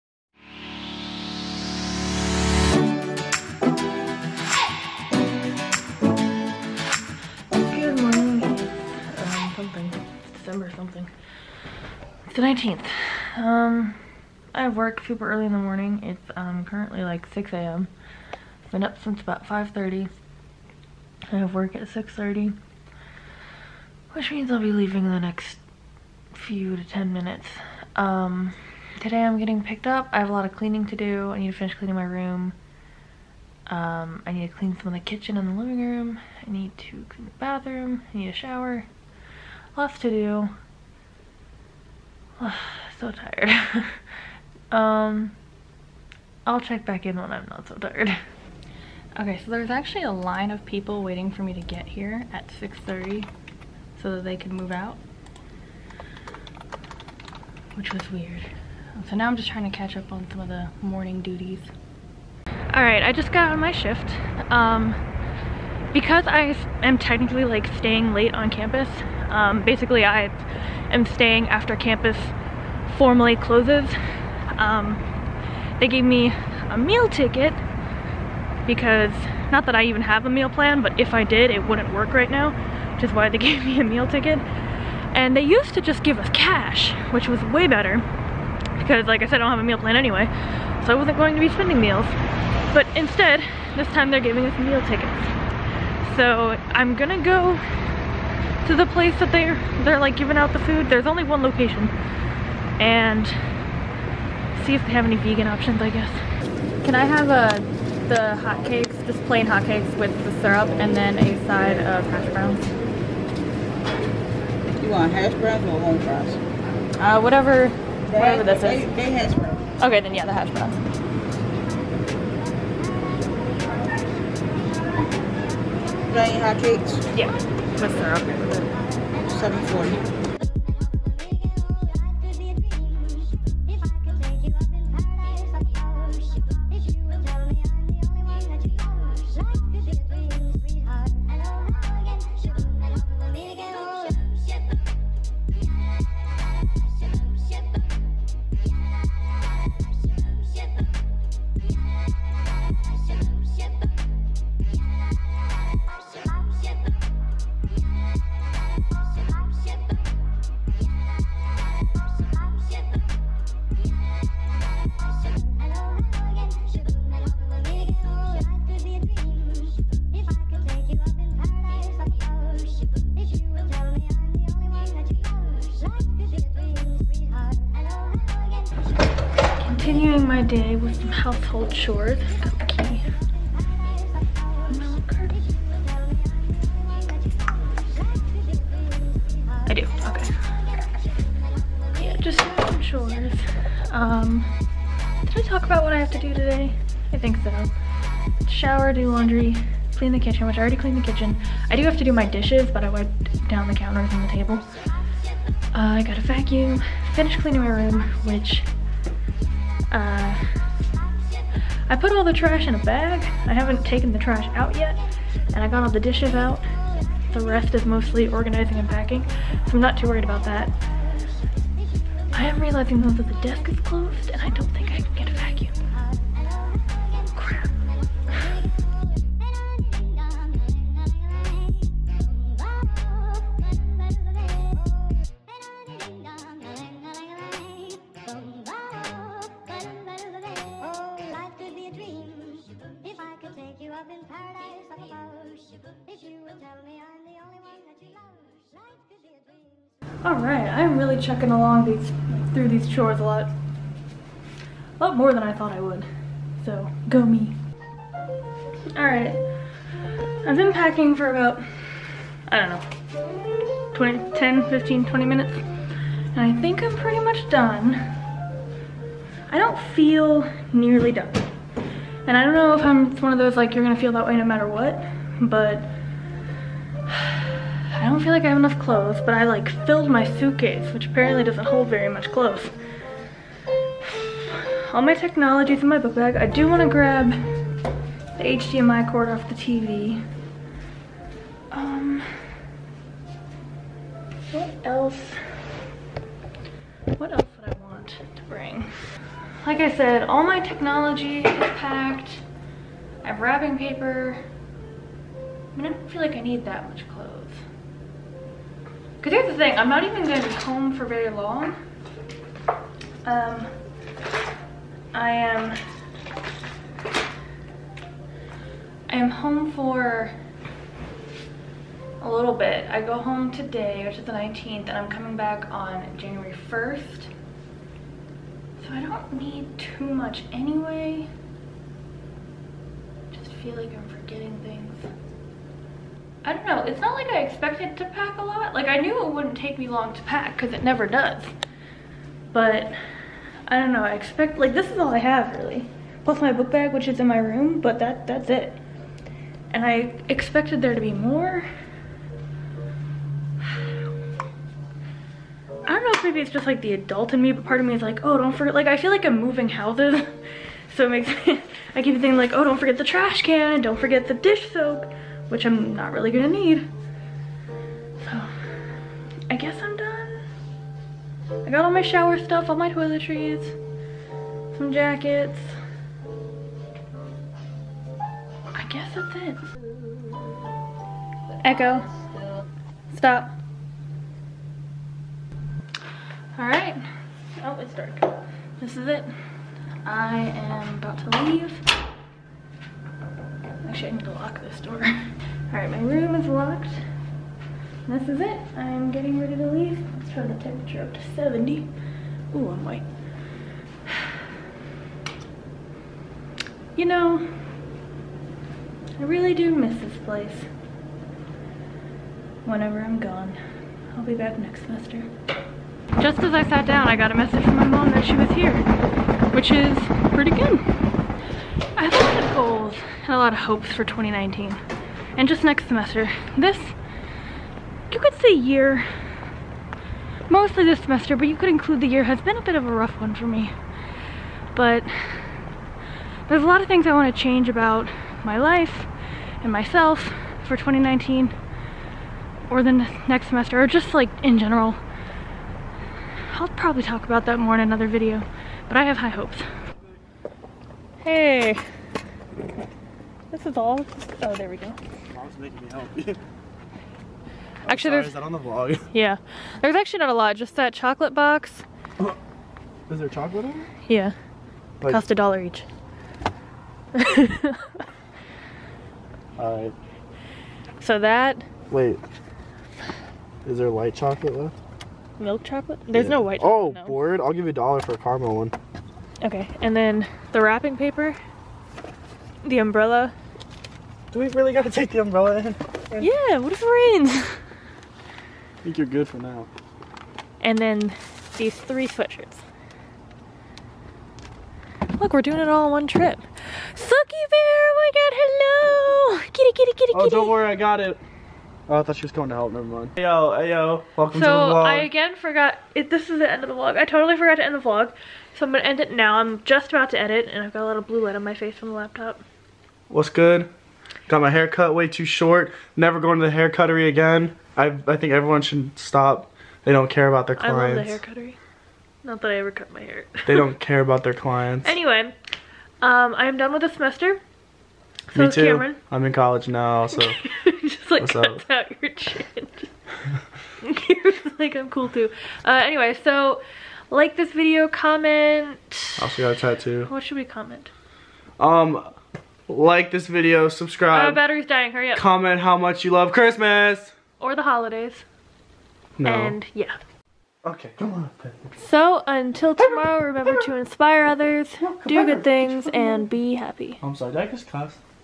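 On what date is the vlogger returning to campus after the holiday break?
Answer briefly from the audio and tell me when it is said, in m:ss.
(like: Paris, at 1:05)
January 1st, at 5:26.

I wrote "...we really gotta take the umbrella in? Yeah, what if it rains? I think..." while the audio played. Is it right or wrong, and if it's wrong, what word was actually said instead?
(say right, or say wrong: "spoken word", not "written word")
right.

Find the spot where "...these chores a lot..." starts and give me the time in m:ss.
4:12.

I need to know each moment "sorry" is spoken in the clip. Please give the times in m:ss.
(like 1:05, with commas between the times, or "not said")
7:38, 9:17.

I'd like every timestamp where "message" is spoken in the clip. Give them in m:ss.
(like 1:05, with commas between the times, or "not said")
6:57.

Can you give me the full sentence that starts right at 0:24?
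Which means I'll be leaving in the next few to 10 minutes.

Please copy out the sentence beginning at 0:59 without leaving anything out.
So now I'm just trying to catch up on some of the morning duties.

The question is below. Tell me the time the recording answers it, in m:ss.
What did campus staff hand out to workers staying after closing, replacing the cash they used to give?
1:34.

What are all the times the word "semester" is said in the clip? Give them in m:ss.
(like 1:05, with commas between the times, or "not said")
6:54, 7:05, 7:10, 7:23, 8:46.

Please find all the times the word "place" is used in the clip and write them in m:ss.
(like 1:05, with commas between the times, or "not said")
1:38, 6:50.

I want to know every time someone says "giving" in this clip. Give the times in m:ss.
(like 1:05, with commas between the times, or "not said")
1:34, 1:40.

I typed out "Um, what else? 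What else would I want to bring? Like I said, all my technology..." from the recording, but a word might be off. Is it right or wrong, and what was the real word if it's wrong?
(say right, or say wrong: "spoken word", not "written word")
right.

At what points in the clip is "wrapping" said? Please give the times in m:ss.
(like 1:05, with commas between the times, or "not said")
5:03, 8:00.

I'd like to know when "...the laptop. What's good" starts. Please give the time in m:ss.
8:31.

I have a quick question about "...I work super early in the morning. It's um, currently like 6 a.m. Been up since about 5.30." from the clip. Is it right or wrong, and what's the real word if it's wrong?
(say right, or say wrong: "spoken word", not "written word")
right.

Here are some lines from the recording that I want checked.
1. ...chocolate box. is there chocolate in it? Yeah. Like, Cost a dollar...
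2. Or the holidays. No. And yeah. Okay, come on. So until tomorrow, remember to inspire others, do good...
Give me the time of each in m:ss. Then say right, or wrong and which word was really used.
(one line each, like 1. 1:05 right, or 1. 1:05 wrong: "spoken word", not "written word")
1. 7:40 right
2. 9:07 right.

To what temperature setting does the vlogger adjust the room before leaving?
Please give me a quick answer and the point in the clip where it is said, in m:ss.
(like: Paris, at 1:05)
70, at 6:41.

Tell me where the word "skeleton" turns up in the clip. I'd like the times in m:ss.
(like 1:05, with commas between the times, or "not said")
not said.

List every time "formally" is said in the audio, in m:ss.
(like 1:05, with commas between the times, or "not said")
1:12.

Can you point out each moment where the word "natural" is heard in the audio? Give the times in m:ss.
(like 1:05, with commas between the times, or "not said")
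not said.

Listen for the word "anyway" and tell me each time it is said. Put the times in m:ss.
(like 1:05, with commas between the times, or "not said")
1:29, 5:30, 8:44, 8:55.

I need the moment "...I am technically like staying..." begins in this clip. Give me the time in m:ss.
1:06.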